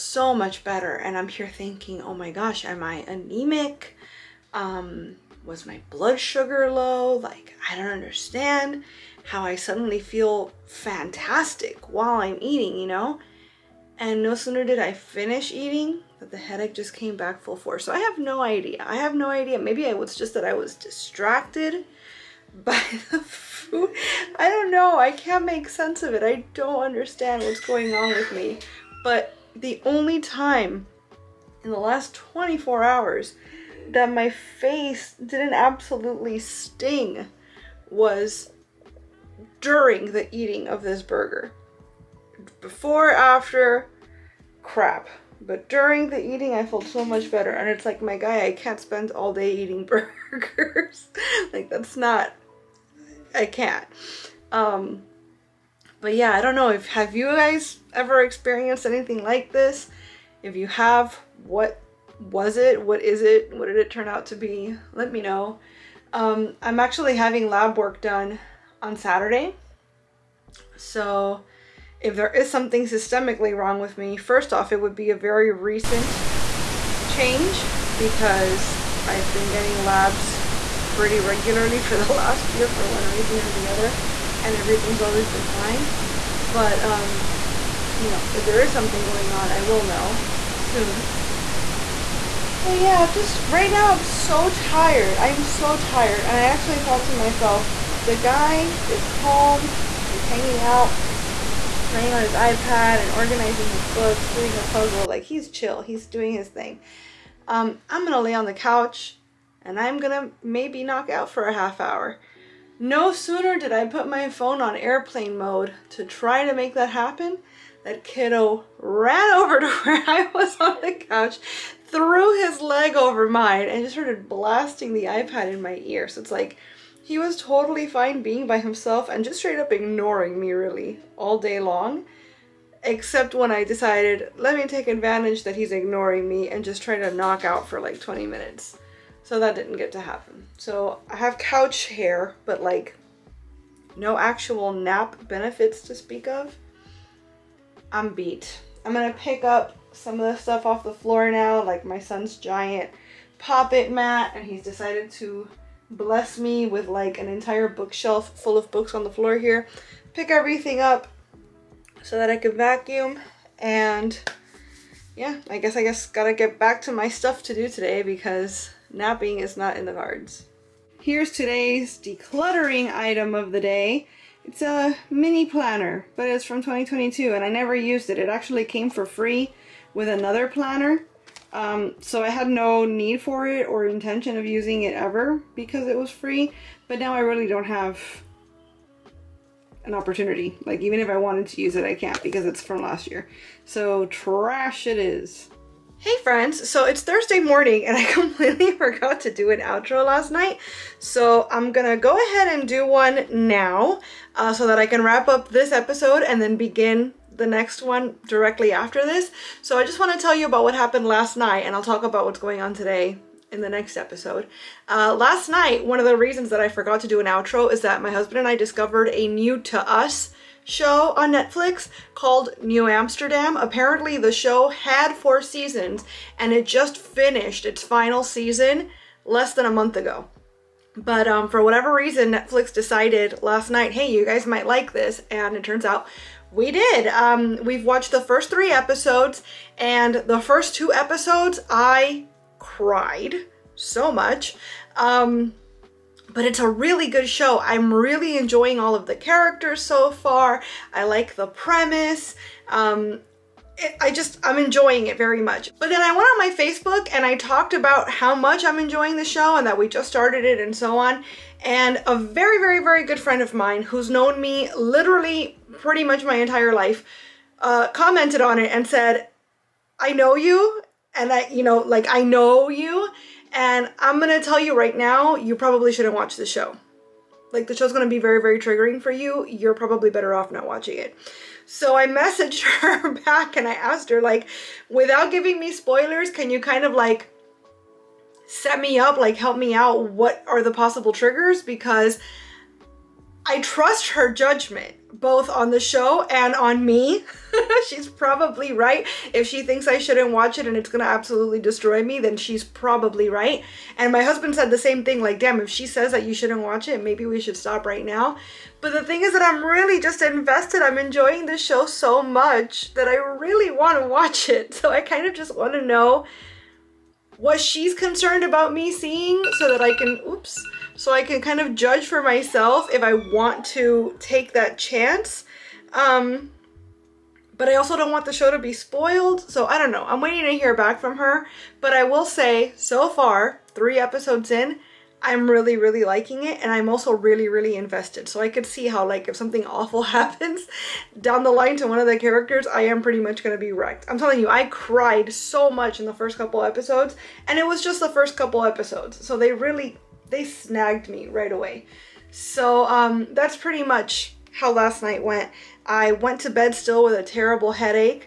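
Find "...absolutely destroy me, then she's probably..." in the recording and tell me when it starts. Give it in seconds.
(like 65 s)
301 s.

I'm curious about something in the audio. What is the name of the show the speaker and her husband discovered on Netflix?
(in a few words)
New Amsterdam.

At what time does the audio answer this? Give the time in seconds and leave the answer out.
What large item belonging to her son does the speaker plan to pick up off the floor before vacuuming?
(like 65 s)
153 s.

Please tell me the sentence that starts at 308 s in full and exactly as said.
But the thing is that I'm really just invested.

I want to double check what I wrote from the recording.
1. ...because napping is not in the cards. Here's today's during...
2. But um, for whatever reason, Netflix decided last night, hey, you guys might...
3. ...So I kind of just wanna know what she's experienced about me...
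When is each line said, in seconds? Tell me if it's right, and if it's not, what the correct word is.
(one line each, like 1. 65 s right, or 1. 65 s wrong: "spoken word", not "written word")
1. 168 s wrong: "decluttering", not "during"
2. 230 s right
3. 314 s wrong: "concerned", not "experienced".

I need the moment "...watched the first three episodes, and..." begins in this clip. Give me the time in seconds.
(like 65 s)
237 s.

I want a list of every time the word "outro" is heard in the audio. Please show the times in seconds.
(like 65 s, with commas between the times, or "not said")
199 s, 217 s.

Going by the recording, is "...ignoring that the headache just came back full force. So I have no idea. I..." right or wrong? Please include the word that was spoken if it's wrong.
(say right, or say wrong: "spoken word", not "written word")
wrong: "eating", not "ignoring".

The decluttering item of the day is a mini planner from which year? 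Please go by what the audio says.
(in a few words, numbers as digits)
2022.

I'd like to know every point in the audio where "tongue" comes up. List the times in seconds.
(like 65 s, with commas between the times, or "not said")
not said.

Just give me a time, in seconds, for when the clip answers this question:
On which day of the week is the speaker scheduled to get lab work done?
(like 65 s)
68 s.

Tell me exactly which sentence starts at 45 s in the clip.
But during the eating, I felt so much better.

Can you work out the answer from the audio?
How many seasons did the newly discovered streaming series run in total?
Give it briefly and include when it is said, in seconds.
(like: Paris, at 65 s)
4, at 225 s.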